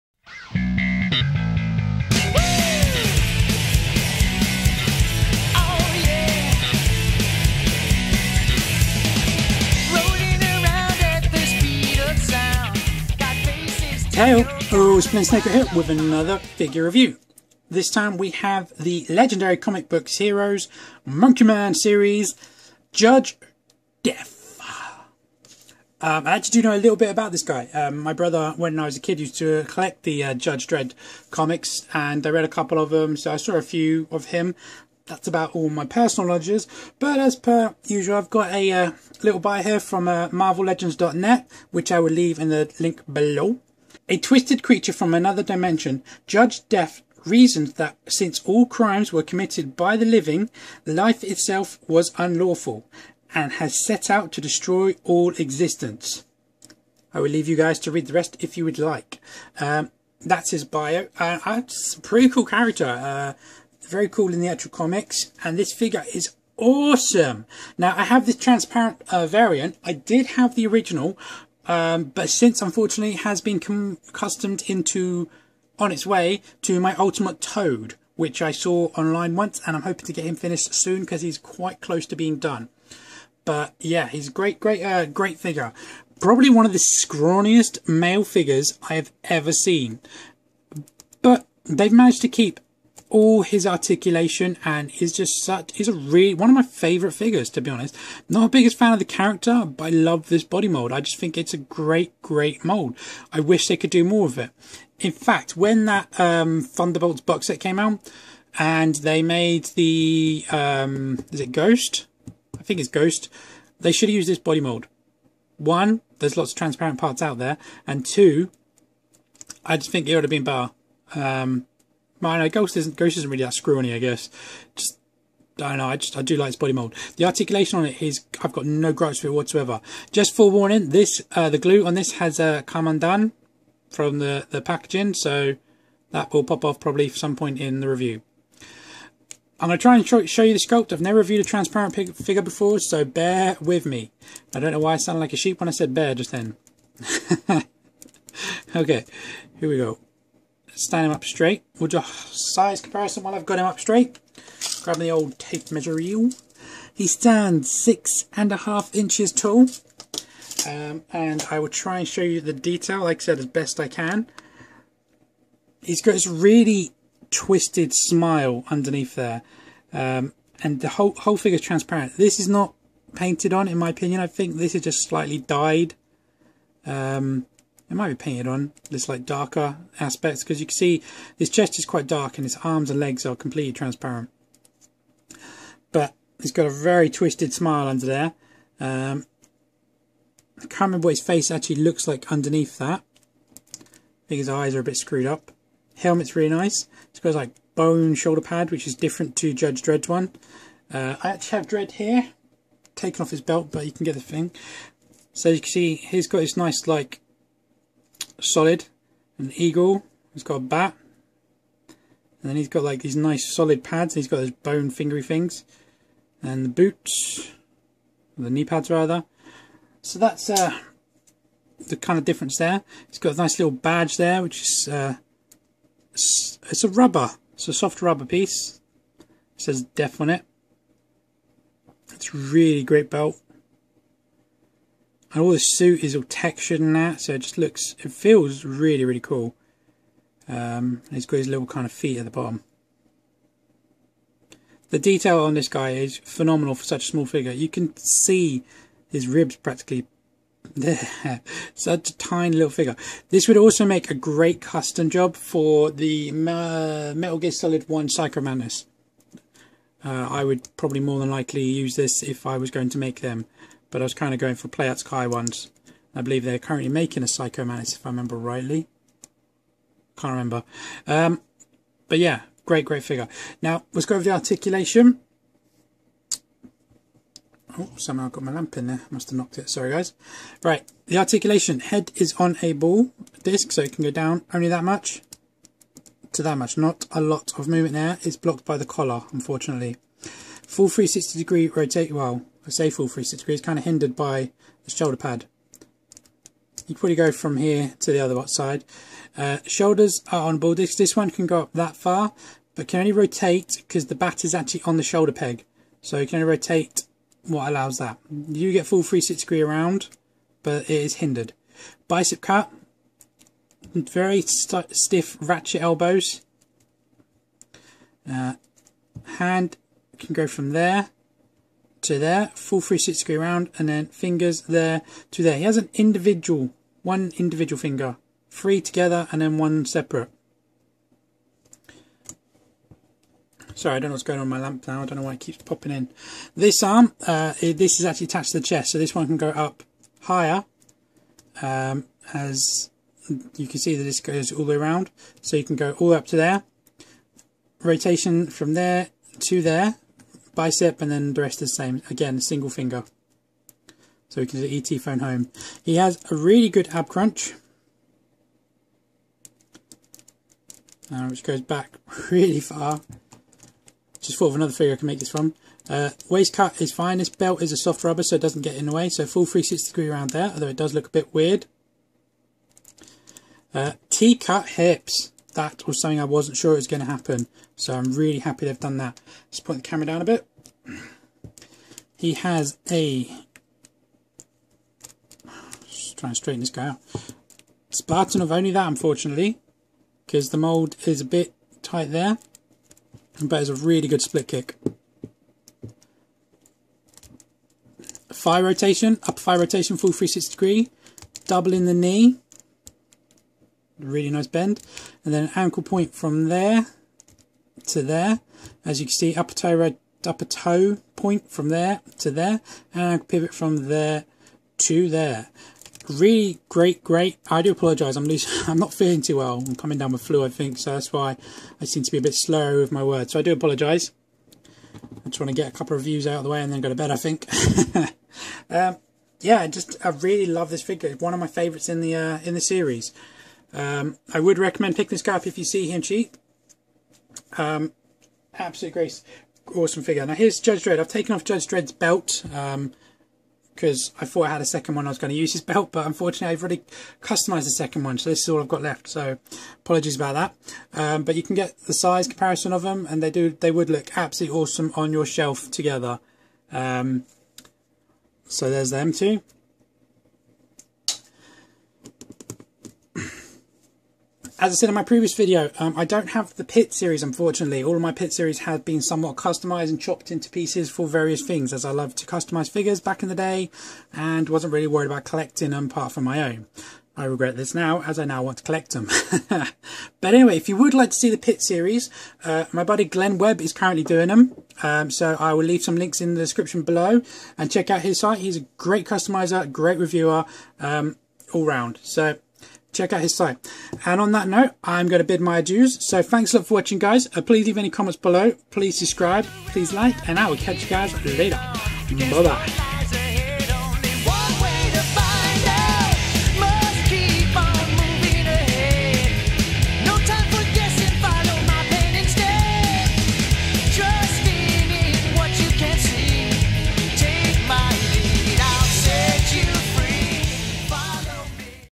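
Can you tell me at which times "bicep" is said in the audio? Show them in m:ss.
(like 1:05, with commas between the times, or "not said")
5:12, 5:50.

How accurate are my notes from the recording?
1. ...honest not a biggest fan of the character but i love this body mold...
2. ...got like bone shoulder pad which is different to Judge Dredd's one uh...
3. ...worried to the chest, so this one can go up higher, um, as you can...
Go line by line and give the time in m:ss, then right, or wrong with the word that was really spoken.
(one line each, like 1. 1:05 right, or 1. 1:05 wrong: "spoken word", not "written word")
1. 1:37 right
2. 3:17 right
3. 5:38 wrong: "attached", not "worried".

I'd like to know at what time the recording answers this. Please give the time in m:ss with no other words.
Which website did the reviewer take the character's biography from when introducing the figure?
0:40.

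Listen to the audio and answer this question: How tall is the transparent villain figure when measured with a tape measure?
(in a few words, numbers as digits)
6.5 inches.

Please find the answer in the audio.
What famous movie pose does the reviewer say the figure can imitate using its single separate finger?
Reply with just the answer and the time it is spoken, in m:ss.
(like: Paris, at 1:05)
ET phone home, at 5:54.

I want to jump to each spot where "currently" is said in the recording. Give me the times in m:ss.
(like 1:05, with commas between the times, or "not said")
4:26, 8:03.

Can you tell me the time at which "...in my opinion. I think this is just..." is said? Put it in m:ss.
2:53.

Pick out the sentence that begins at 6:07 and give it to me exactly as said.
This belt is a soft rubber so it doesn't get in the way.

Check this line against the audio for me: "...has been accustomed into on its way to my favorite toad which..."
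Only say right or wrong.
wrong.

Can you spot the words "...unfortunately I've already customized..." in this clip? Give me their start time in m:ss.
7:26.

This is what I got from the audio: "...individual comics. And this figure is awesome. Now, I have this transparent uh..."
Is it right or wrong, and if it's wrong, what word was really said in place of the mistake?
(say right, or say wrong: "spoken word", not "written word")
wrong: "actual", not "individual".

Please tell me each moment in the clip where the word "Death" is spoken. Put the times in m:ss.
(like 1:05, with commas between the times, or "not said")
0:24, 0:46.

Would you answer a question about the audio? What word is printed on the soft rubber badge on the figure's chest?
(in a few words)
Def.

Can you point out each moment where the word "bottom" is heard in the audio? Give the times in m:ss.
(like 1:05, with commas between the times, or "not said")
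4:02.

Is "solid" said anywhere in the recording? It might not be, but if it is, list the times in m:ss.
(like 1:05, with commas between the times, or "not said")
3:28, 3:33, 4:17.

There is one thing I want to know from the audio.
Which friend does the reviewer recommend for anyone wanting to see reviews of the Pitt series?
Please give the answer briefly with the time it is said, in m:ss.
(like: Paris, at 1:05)
Glen Webb, at 8:03.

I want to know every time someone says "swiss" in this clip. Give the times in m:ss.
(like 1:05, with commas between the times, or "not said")
not said.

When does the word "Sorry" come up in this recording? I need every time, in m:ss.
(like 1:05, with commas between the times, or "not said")
4:39, 5:33.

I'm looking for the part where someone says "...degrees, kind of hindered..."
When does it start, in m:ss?
4:53.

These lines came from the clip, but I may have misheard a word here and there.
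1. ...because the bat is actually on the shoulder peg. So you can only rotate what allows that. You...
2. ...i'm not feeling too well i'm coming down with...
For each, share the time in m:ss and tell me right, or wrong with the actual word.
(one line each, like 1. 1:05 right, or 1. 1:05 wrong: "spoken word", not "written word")
1. 5:03 right
2. 6:58 right.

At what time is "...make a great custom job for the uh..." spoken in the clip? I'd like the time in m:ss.
4:13.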